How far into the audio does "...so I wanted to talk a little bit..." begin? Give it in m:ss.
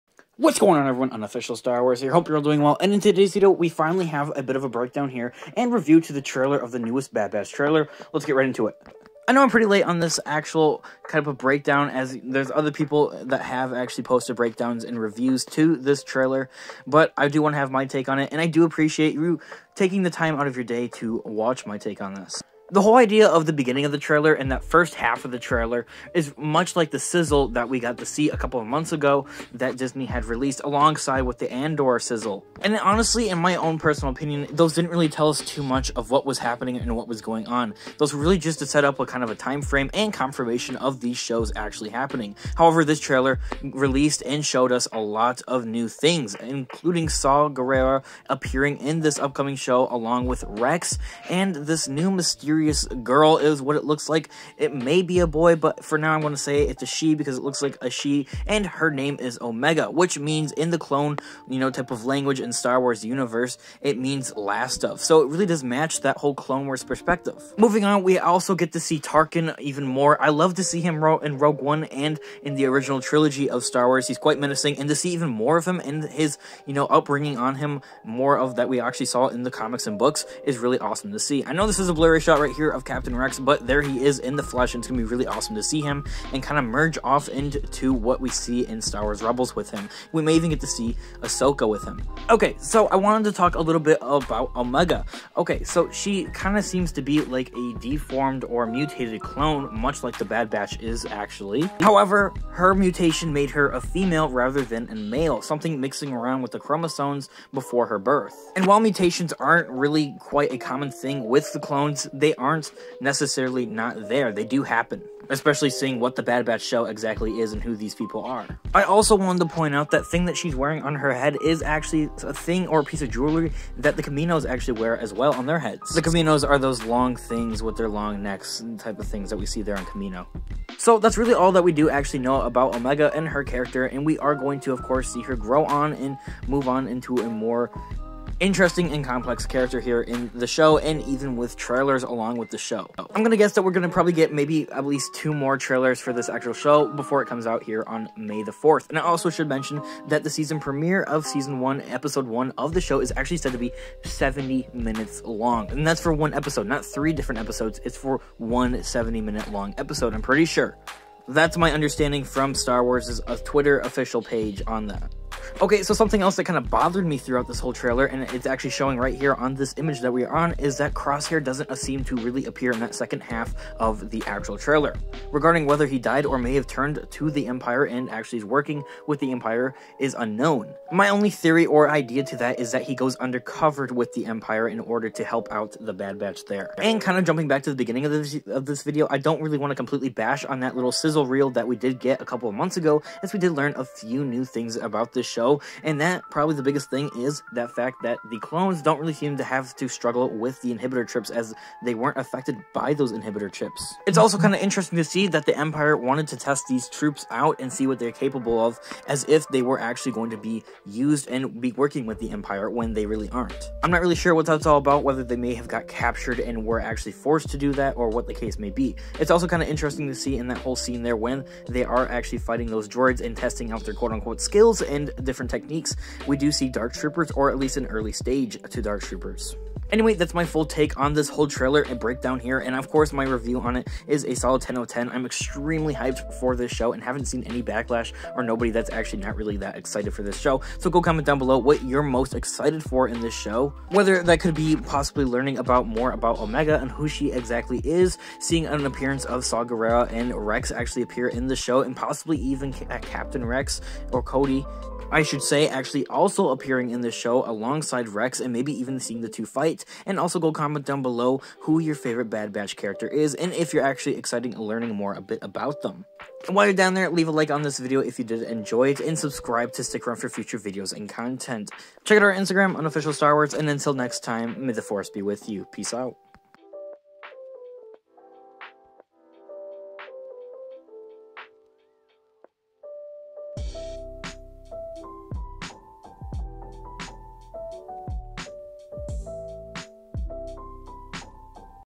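1:32.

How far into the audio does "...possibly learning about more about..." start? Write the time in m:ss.
4:04.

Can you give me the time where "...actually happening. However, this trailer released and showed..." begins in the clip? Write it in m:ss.
0:41.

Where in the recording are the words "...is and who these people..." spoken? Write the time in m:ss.
1:57.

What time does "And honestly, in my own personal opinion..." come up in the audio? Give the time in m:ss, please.
0:32.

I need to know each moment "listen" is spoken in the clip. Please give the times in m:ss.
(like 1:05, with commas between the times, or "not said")
not said.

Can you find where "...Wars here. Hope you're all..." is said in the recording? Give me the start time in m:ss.
0:01.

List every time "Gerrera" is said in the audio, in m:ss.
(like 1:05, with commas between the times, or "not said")
0:47, 4:09.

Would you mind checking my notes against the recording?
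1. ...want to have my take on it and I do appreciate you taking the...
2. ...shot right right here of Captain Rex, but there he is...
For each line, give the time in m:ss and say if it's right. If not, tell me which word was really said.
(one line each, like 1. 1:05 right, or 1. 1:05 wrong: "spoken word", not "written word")
1. 0:17 right
2. 1:22 right.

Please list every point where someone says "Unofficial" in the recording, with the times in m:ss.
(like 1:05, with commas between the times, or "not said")
0:01, 4:32.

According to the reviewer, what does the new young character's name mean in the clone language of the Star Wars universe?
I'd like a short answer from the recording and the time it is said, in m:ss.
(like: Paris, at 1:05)
Last of, at 1:04.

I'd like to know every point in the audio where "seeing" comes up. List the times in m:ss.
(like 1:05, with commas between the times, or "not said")
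1:55, 4:08, 4:18.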